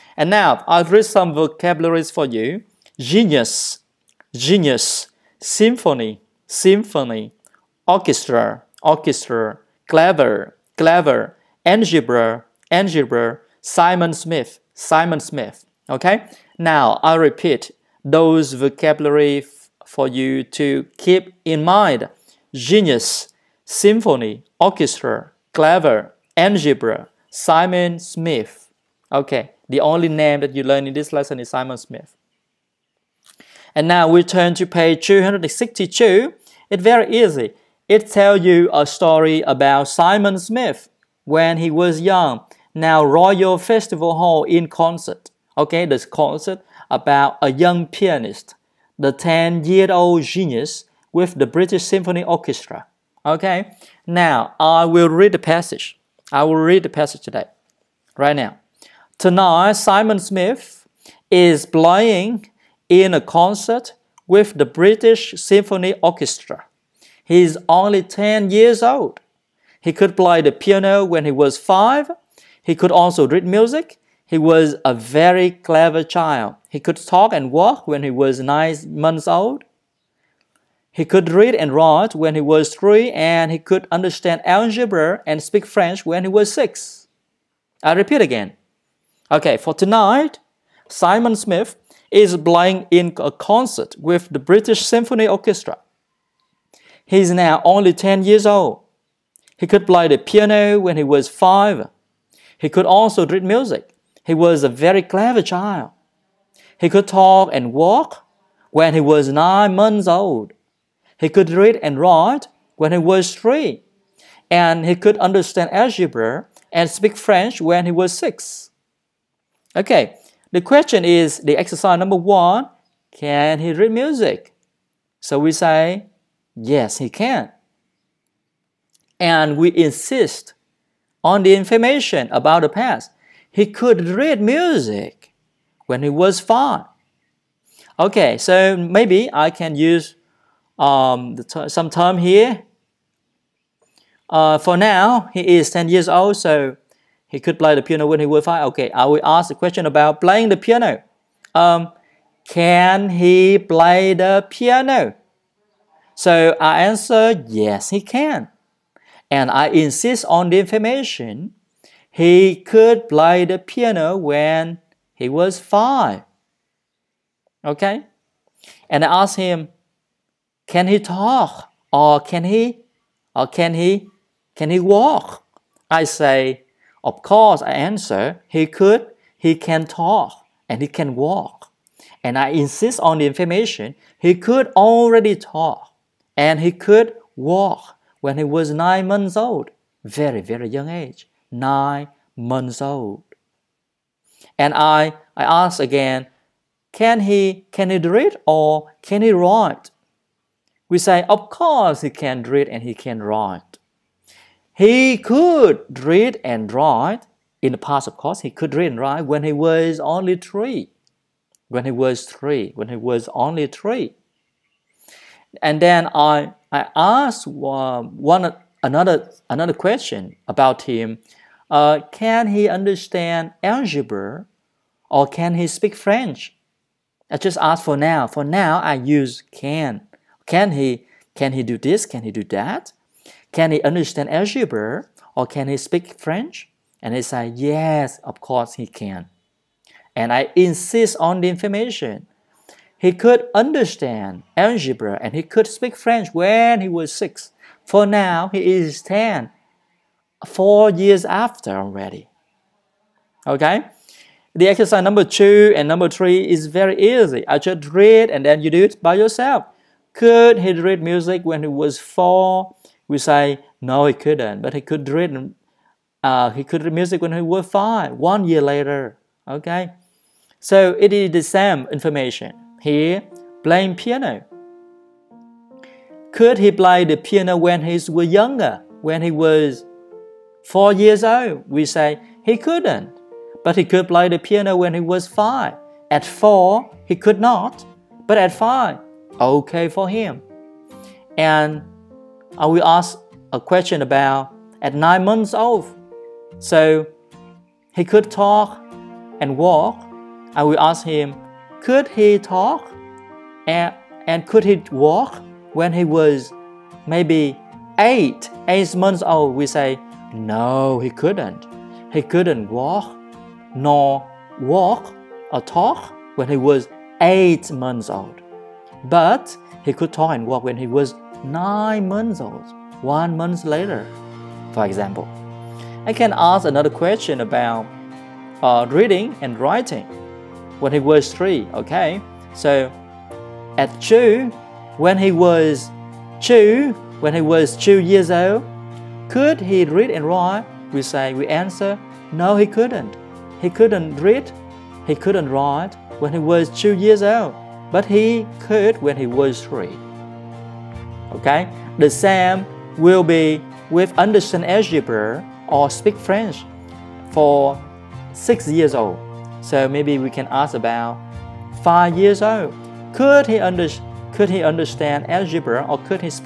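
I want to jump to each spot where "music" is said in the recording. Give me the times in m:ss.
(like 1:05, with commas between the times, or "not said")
1:13, 1:43, 2:03, 2:14, 4:21, 4:26.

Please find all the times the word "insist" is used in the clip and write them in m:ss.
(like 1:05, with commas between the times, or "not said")
2:09, 2:39, 3:02, 4:00.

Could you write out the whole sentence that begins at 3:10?
Very, very young age, nine months old.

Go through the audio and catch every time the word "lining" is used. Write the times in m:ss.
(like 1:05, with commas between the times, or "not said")
not said.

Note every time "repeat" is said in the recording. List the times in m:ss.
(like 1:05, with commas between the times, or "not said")
0:17, 1:27.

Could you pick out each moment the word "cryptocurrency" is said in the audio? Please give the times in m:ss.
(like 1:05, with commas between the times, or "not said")
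not said.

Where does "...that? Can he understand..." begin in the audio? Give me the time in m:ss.
3:52.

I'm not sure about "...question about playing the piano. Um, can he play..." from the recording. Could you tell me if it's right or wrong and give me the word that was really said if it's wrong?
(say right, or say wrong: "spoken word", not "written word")
right.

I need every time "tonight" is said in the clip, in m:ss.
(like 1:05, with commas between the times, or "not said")
0:59, 1:29.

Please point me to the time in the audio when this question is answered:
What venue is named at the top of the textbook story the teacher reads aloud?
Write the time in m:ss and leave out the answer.
0:43.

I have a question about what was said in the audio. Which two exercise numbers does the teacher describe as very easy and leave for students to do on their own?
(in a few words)
2 and 3.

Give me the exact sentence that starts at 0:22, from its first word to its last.
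Genius, symphony, orchestra, clever, algebra, Simon Smith.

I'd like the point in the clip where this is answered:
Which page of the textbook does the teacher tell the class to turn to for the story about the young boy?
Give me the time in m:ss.
0:35.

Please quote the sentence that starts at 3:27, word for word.
In the past, of course, he could read and write when he was only three.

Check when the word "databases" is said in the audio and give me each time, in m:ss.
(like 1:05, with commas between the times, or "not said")
not said.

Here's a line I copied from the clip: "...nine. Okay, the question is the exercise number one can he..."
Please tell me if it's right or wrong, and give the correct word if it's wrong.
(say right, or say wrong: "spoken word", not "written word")
wrong: "six", not "nine".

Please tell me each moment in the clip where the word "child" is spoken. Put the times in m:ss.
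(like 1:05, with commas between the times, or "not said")
1:16, 1:45.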